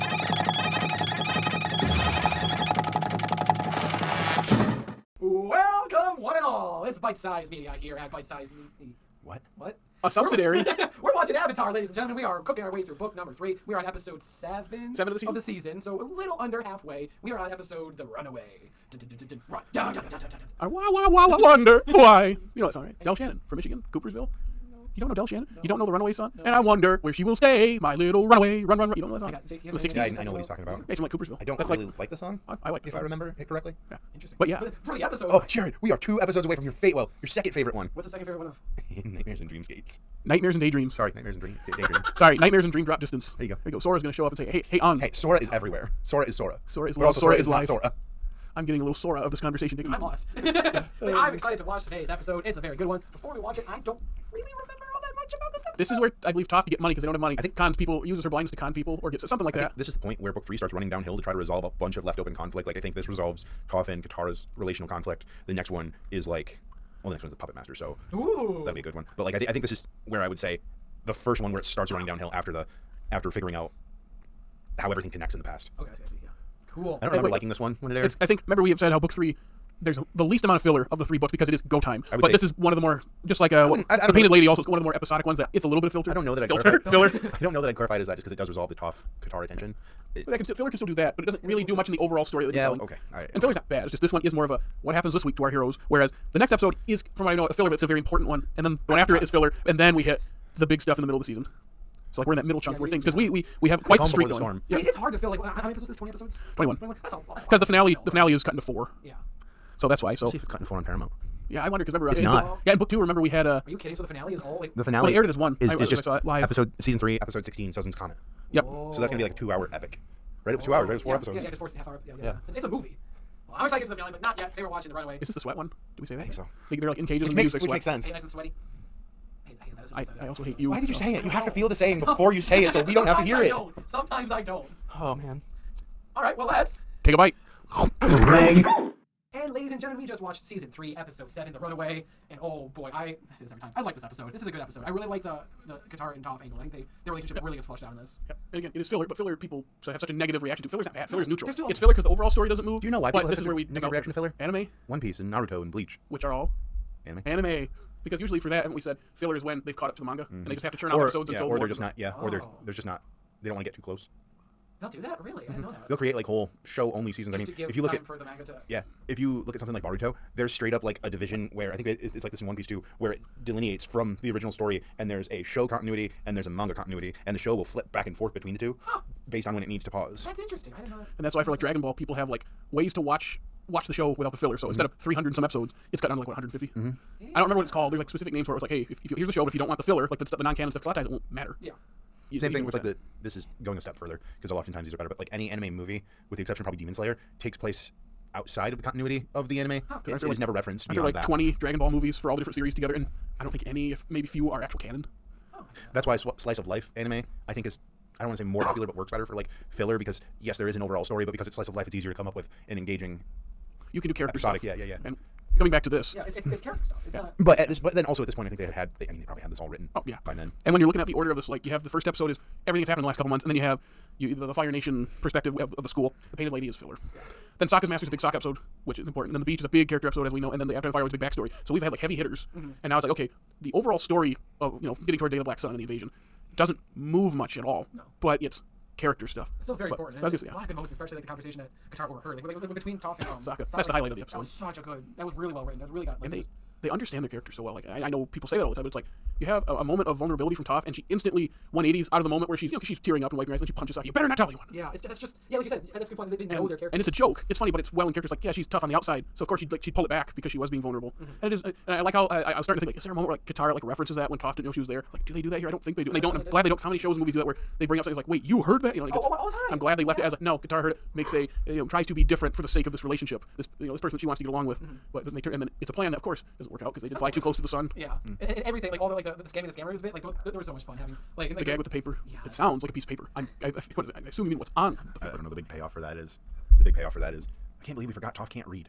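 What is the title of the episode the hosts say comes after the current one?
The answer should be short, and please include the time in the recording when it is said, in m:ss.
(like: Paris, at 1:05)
The Puppet Master, at 1:07.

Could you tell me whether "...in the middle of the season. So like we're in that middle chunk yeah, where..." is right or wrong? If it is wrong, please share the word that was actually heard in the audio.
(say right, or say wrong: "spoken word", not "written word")
right.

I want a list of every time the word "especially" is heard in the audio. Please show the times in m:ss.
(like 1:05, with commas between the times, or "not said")
4:00.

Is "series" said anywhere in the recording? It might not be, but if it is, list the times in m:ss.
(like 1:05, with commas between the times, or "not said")
3:22.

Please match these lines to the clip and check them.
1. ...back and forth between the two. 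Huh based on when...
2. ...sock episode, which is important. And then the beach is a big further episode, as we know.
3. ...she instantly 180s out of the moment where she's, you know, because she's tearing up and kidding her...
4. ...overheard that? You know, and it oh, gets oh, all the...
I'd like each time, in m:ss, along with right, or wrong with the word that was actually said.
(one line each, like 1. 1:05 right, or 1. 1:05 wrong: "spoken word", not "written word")
1. 2:57 right
2. 3:48 wrong: "character", not "further"
3. 4:10 wrong: "wiping", not "kidding"
4. 4:28 wrong: "heard", not "overheard".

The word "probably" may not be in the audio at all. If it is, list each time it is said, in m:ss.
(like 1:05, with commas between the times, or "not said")
3:16, 3:39.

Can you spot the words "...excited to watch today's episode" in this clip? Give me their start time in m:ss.
0:51.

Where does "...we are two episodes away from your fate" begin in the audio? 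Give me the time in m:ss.
0:35.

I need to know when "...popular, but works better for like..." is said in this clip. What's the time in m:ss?
3:28.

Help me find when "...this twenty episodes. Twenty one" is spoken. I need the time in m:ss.
1:45.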